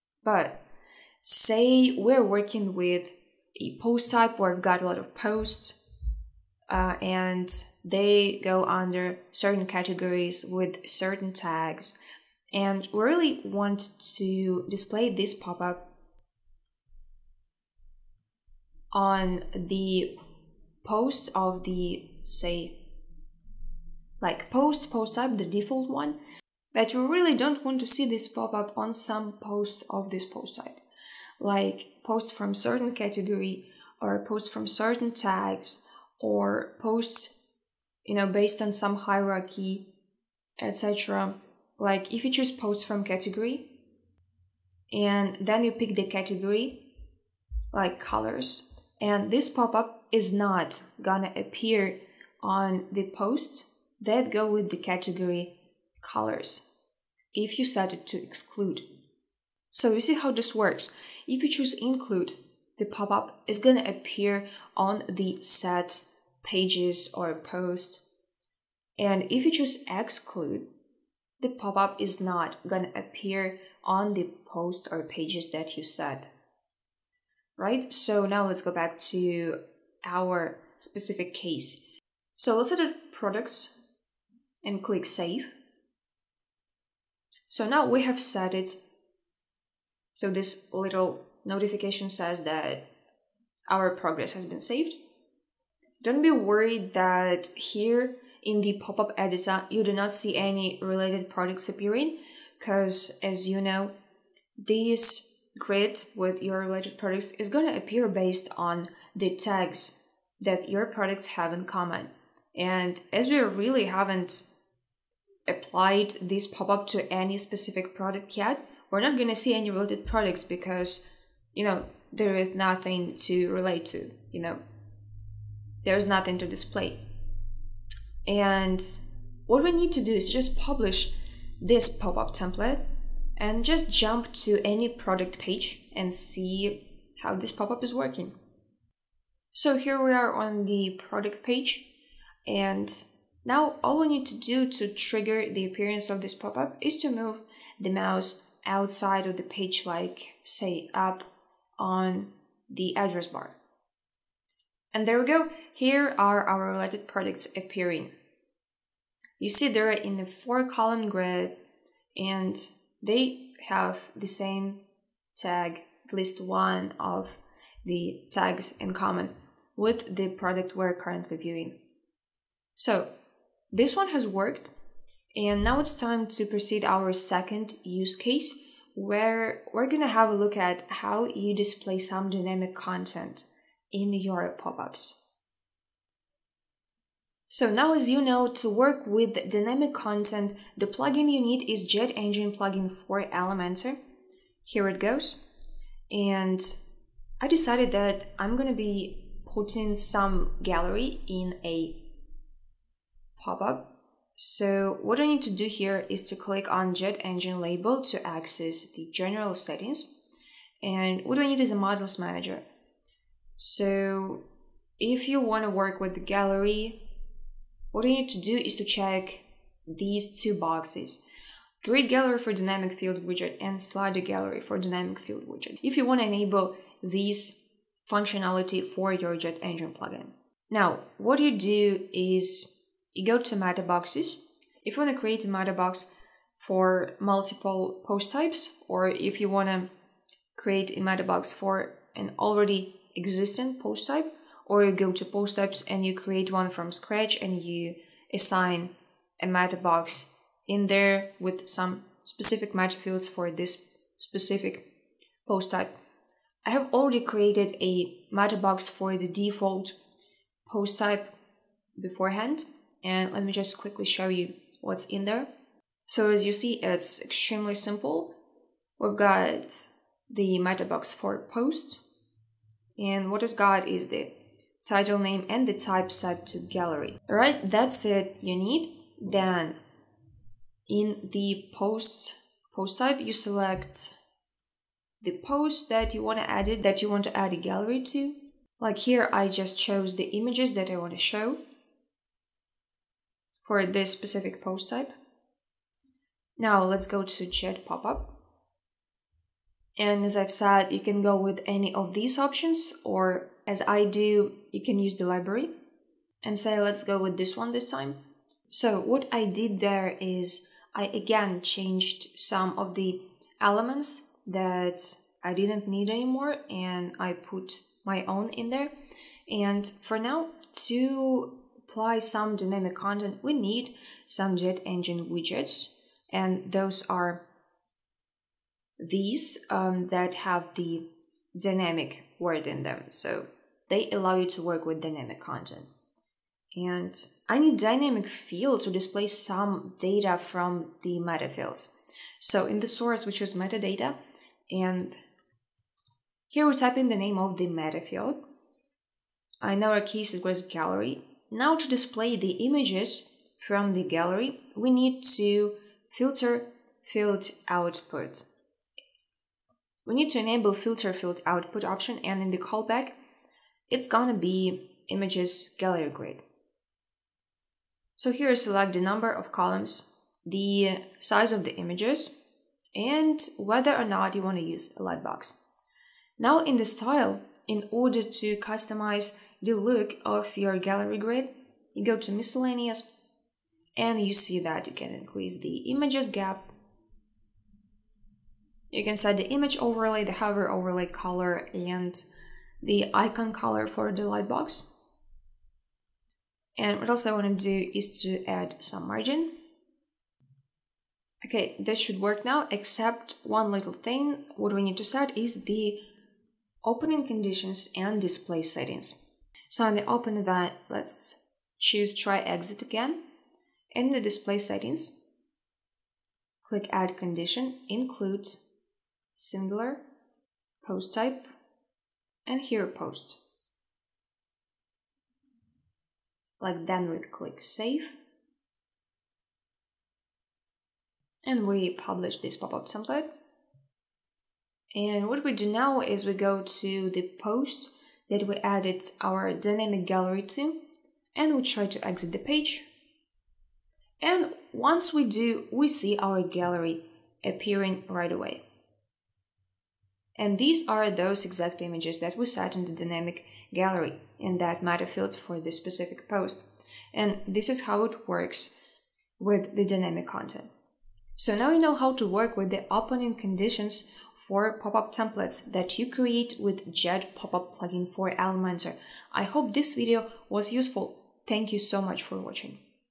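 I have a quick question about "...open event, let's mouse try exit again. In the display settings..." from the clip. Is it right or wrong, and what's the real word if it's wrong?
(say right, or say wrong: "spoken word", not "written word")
wrong: "choose", not "mouse".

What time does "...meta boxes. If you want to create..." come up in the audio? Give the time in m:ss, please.
3:53.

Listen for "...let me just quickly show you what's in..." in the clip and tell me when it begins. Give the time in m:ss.
4:23.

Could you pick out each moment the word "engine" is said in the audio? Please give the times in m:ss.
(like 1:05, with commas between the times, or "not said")
3:12, 3:27, 3:49, 5:24.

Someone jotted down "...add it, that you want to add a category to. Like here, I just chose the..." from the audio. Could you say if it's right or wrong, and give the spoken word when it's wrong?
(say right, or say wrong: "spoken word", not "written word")
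wrong: "gallery", not "category".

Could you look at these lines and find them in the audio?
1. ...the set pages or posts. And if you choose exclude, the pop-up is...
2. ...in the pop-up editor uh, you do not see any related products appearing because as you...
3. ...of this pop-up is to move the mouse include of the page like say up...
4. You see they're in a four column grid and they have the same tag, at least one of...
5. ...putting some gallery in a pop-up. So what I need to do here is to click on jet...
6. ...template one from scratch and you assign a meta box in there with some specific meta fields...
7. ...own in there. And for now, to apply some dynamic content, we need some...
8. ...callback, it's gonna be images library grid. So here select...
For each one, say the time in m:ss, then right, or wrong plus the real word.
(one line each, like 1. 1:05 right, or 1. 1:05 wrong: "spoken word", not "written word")
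1. 1:05 right
2. 1:38 right
3. 2:26 wrong: "outside", not "include"
4. 2:39 right
5. 3:19 right
6. 4:06 wrong: "create", not "template"
7. 5:18 right
8. 6:02 wrong: "gallery", not "library".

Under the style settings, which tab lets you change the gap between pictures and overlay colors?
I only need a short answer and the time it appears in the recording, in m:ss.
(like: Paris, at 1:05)
miscellaneous, at 6:22.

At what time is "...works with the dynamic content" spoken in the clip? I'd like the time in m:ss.
7:38.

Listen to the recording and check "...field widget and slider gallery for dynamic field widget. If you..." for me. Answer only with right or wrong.
right.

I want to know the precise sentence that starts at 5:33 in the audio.
So they allow you to work with dynamic content.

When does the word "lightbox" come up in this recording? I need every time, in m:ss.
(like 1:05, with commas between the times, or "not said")
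6:15, 6:34.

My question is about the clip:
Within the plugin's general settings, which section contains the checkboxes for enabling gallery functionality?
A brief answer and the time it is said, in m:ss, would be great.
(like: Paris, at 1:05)
modules manager, at 3:31.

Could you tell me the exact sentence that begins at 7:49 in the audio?
I hope this video was useful.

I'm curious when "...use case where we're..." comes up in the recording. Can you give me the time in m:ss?
2:57.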